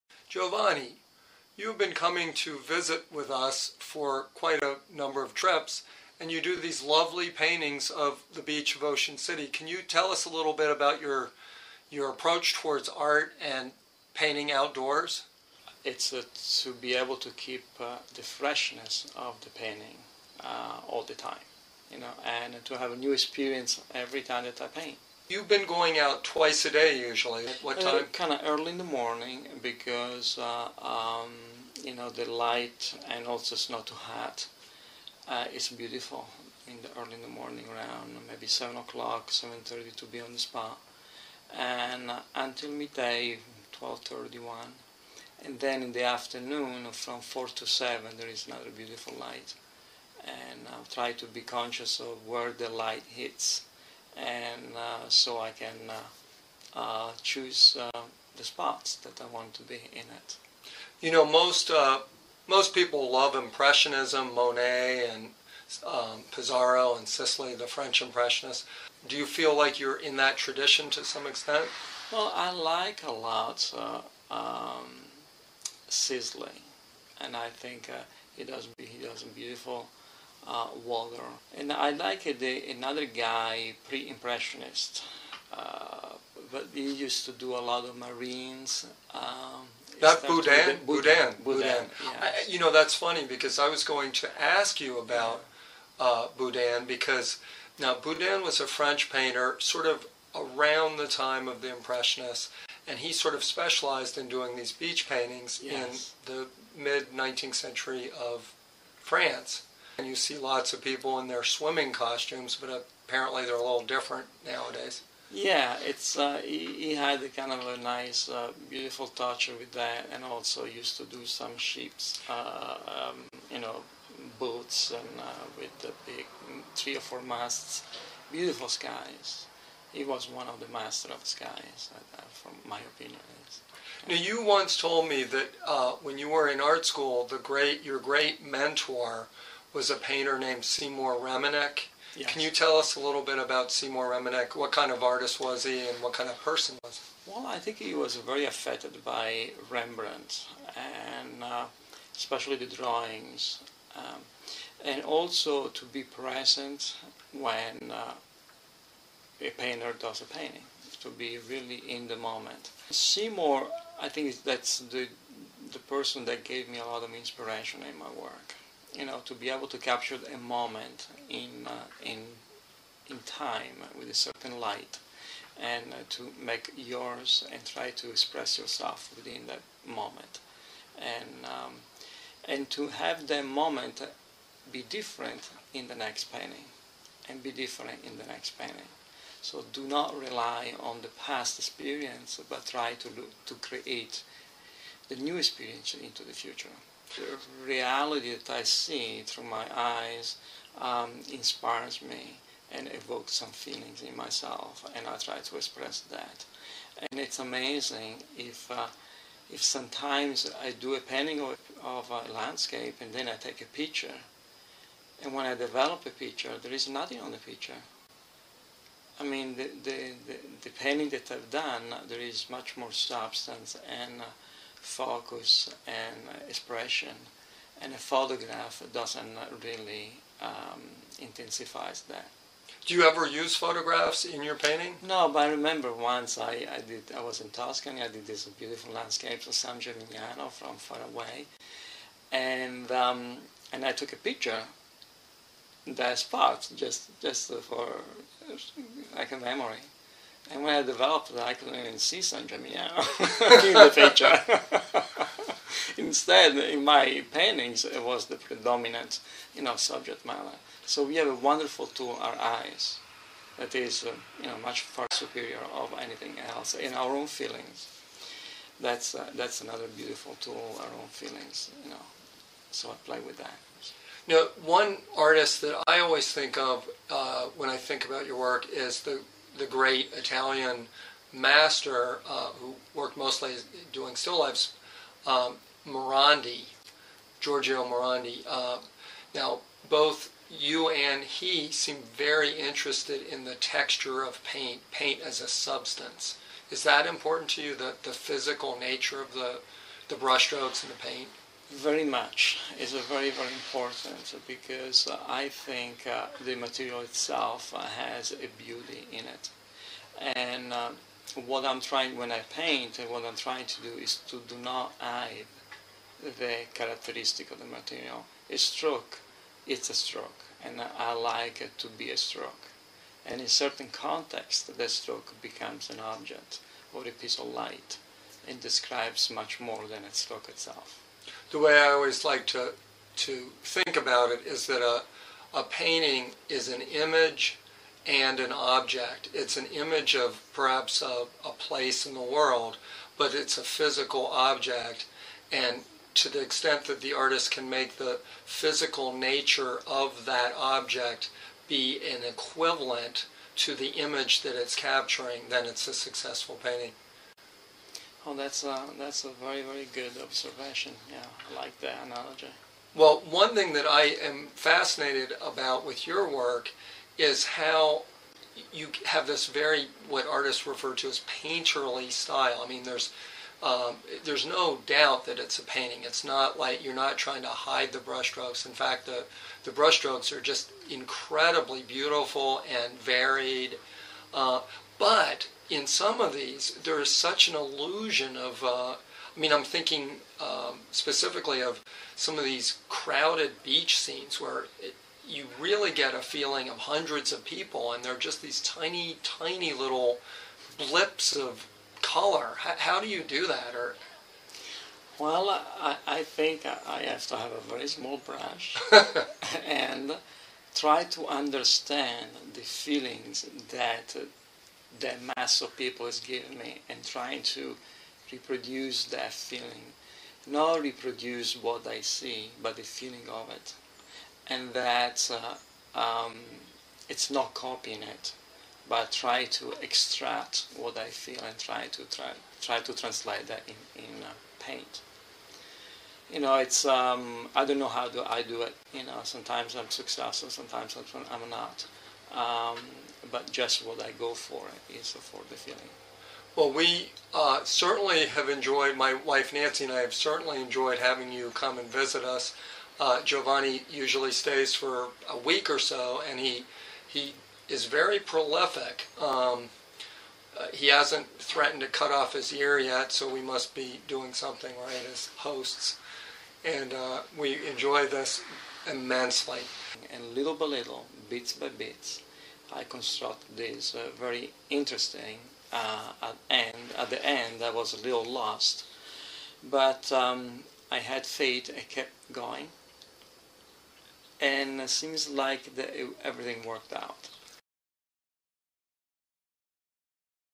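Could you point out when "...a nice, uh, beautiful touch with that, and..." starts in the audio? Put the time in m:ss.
1:57.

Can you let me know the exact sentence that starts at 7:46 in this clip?
And uh, we enjoy this immensely.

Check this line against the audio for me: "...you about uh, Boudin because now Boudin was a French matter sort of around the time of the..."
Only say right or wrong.
wrong.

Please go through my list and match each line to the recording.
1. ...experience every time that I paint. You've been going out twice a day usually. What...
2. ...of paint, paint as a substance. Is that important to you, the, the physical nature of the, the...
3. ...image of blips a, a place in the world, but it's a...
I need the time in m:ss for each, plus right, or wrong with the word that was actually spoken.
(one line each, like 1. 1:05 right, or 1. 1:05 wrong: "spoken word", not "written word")
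1. 0:23 right
2. 4:54 right
3. 5:39 wrong: "perhaps", not "blips".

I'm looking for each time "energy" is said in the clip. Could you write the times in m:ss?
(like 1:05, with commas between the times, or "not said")
not said.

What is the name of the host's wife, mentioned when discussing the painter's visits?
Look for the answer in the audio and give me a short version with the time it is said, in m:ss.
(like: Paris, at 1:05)
Nancy, at 7:29.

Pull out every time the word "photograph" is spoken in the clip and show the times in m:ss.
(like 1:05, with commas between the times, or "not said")
3:47, 3:53.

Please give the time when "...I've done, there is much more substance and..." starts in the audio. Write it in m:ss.
3:41.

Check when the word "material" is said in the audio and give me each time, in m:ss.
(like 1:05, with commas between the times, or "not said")
5:06, 5:17.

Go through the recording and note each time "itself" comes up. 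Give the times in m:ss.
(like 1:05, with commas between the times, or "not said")
5:06, 5:30.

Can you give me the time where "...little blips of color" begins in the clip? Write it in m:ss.
6:39.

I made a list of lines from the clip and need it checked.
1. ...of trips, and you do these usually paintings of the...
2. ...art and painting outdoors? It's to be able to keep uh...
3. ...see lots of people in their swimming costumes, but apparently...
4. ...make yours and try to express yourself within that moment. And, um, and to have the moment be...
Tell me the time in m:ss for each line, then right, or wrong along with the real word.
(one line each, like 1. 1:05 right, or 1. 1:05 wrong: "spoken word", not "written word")
1. 0:05 wrong: "lovely", not "usually"
2. 0:12 right
3. 1:50 right
4. 2:56 right.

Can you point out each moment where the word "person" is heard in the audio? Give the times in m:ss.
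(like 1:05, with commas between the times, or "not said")
2:26, 2:45.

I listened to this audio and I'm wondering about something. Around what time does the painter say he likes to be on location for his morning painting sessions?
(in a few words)
7:30.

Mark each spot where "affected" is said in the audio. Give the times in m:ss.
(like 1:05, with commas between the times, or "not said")
2:28.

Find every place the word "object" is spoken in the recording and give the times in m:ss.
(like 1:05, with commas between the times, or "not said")
5:26, 5:38, 5:44, 5:50.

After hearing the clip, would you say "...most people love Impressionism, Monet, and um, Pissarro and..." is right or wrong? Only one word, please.
right.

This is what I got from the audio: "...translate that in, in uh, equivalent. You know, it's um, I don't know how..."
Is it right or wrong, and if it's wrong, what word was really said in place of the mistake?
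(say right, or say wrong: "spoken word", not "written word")
wrong: "paint", not "equivalent".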